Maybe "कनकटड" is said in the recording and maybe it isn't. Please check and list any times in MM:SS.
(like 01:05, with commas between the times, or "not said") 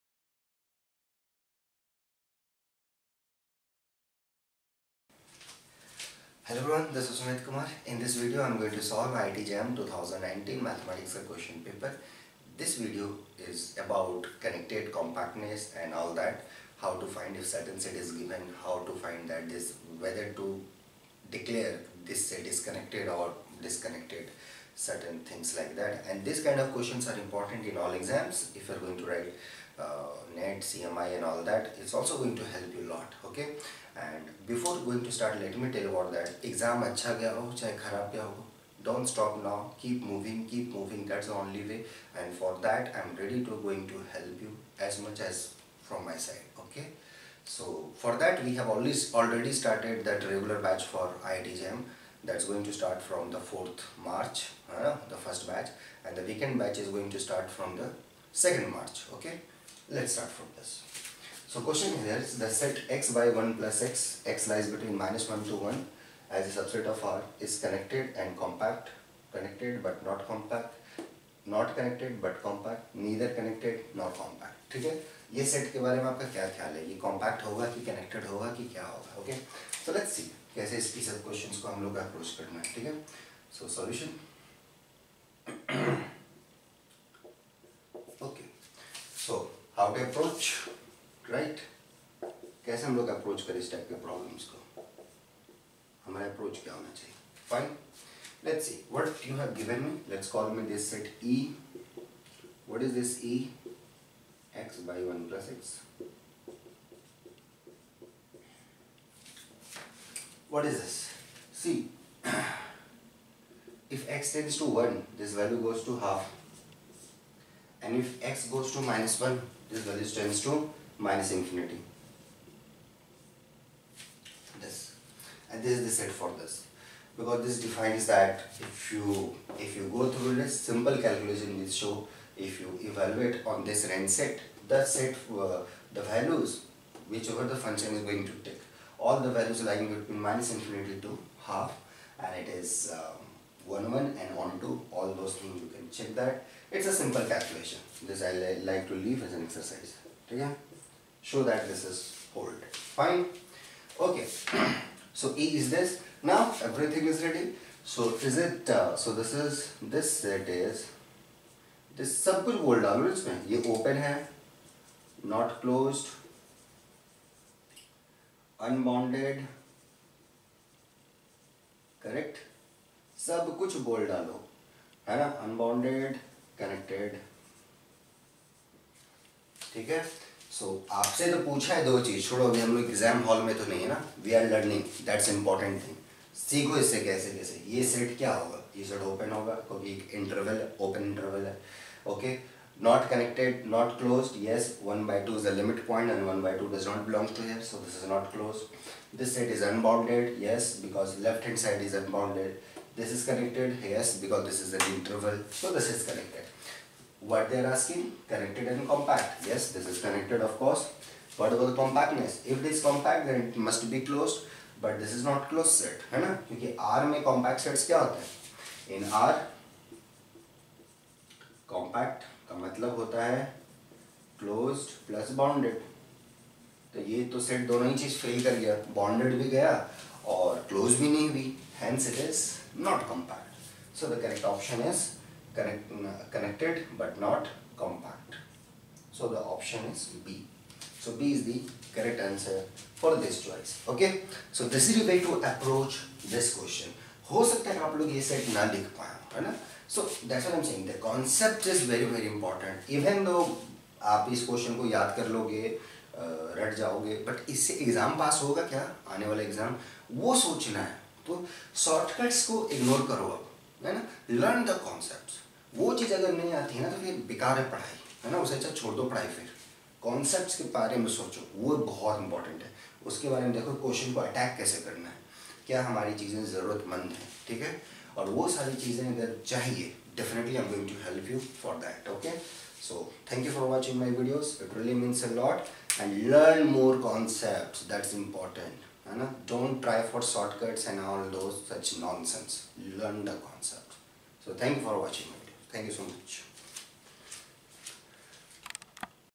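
01:17, 02:56, 03:55.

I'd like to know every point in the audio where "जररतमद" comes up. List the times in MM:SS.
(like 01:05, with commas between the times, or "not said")
04:36.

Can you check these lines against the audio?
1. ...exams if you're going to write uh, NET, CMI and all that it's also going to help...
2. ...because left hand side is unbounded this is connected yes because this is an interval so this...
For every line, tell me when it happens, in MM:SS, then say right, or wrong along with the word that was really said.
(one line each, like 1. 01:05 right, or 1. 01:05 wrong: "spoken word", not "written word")
1. 00:27 right
2. 03:20 right.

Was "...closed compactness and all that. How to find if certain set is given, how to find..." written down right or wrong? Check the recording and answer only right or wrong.
wrong.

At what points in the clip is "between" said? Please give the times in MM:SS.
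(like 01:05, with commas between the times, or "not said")
01:04, 02:19.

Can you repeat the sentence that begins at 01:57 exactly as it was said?
And if x goes to minus 1, this value tends to minus infinity.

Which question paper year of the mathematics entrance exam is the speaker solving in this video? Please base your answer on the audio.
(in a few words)
2019.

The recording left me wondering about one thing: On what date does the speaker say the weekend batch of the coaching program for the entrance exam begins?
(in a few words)
2nd March.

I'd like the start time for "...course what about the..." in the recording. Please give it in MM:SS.
03:30.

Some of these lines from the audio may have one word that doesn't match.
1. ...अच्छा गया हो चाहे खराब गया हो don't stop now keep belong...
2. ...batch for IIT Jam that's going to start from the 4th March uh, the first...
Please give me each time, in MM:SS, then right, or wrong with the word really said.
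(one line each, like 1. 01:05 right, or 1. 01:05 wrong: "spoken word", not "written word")
1. 00:36 wrong: "moving", not "belong"
2. 00:50 right.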